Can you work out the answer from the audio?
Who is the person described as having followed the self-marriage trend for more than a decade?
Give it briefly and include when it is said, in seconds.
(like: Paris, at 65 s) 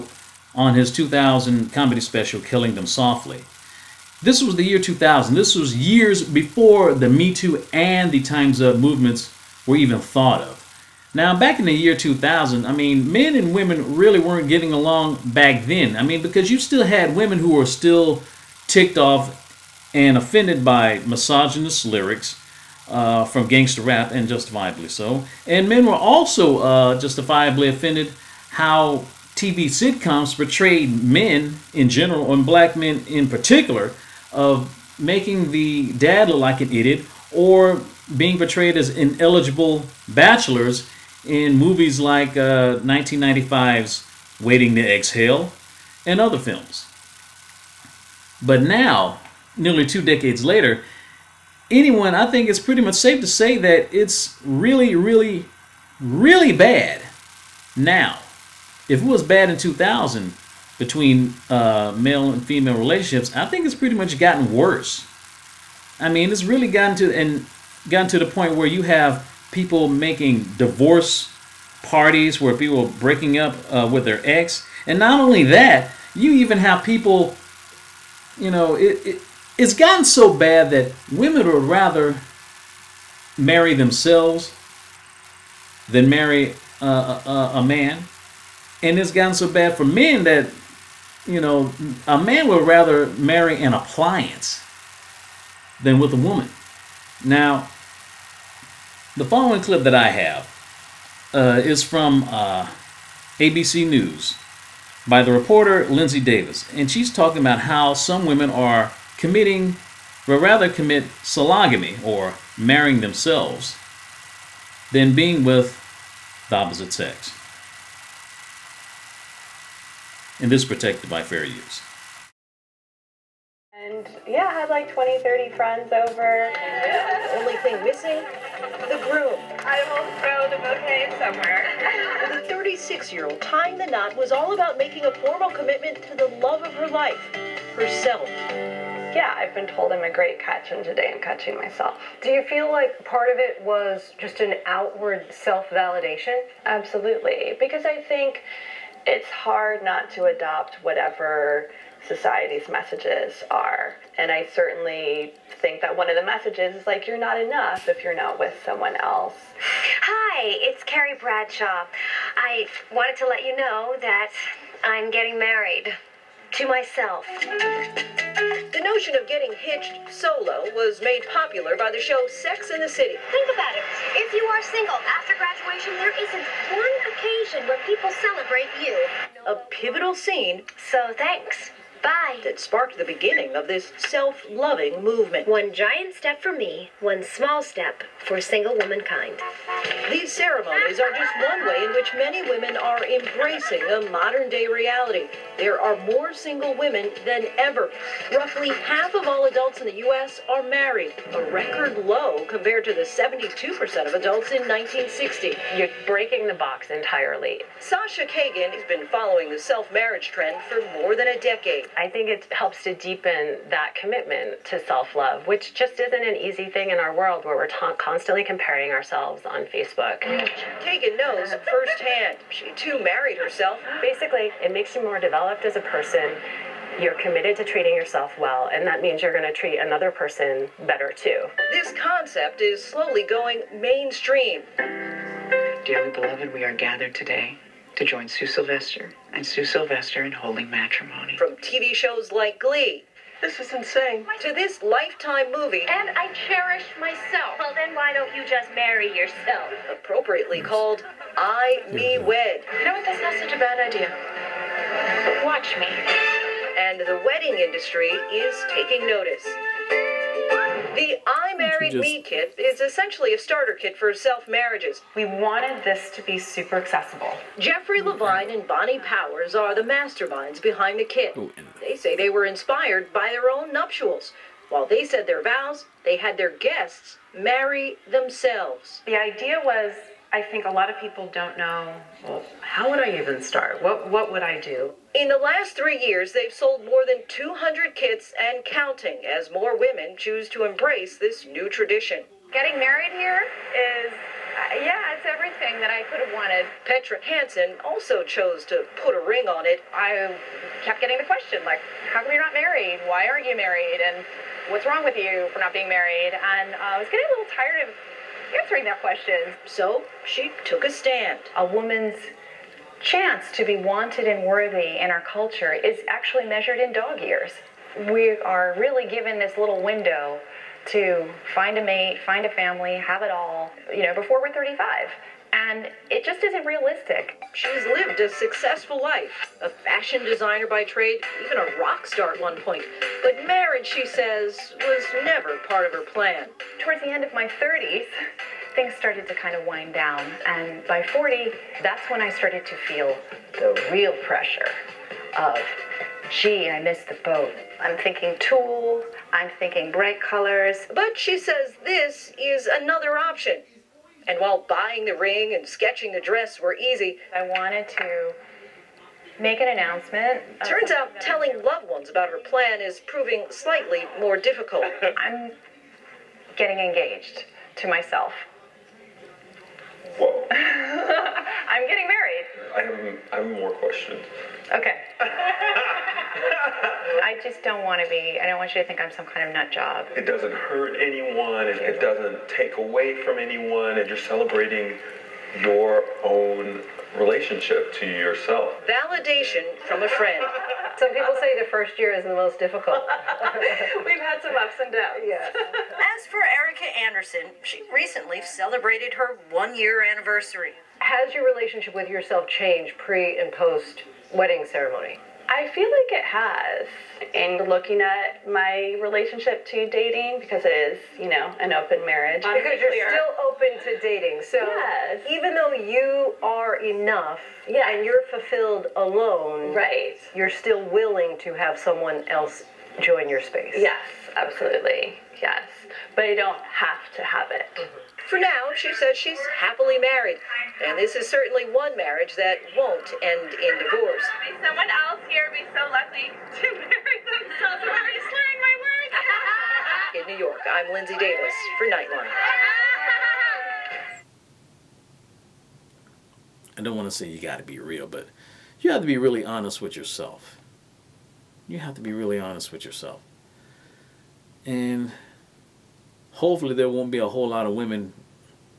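Sasha Cagen, at 207 s.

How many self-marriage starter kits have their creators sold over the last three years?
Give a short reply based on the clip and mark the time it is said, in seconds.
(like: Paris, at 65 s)
more than 200, at 286 s.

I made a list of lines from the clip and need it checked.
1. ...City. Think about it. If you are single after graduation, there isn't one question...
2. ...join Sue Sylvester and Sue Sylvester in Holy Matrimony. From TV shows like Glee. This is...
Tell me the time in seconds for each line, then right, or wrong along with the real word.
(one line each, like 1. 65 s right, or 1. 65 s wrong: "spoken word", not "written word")
1. 172 s wrong: "occasion", not "question"
2. 238 s right.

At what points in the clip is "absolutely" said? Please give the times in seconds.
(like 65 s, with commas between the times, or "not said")
146 s, 424 s.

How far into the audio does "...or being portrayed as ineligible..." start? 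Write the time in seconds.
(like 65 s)
37 s.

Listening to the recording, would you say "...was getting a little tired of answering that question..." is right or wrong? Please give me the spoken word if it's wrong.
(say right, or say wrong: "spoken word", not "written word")
right.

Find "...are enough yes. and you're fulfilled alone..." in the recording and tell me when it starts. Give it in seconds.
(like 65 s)
416 s.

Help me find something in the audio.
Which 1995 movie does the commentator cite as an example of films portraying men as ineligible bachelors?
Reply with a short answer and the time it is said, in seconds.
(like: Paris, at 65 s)
Waiting to Exhale, at 44 s.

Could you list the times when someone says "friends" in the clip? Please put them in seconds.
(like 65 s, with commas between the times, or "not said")
125 s, 390 s.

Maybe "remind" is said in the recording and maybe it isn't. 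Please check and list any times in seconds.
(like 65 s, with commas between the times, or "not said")
not said.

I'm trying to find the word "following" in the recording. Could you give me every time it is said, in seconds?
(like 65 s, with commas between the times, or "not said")
99 s, 209 s.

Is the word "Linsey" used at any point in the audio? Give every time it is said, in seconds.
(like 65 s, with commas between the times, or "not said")
105 s, 440 s.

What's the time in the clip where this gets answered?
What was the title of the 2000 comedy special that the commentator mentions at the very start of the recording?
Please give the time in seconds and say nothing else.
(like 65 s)
2 s.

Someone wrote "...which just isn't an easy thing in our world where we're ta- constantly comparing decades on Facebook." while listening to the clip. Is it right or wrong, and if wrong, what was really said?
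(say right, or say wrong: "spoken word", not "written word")
wrong: "ourselves", not "decades".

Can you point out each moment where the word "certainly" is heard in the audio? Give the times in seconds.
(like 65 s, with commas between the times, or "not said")
154 s, 431 s.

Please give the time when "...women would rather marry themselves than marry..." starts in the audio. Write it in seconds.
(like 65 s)
81 s.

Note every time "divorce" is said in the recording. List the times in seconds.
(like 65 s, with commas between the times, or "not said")
70 s, 433 s.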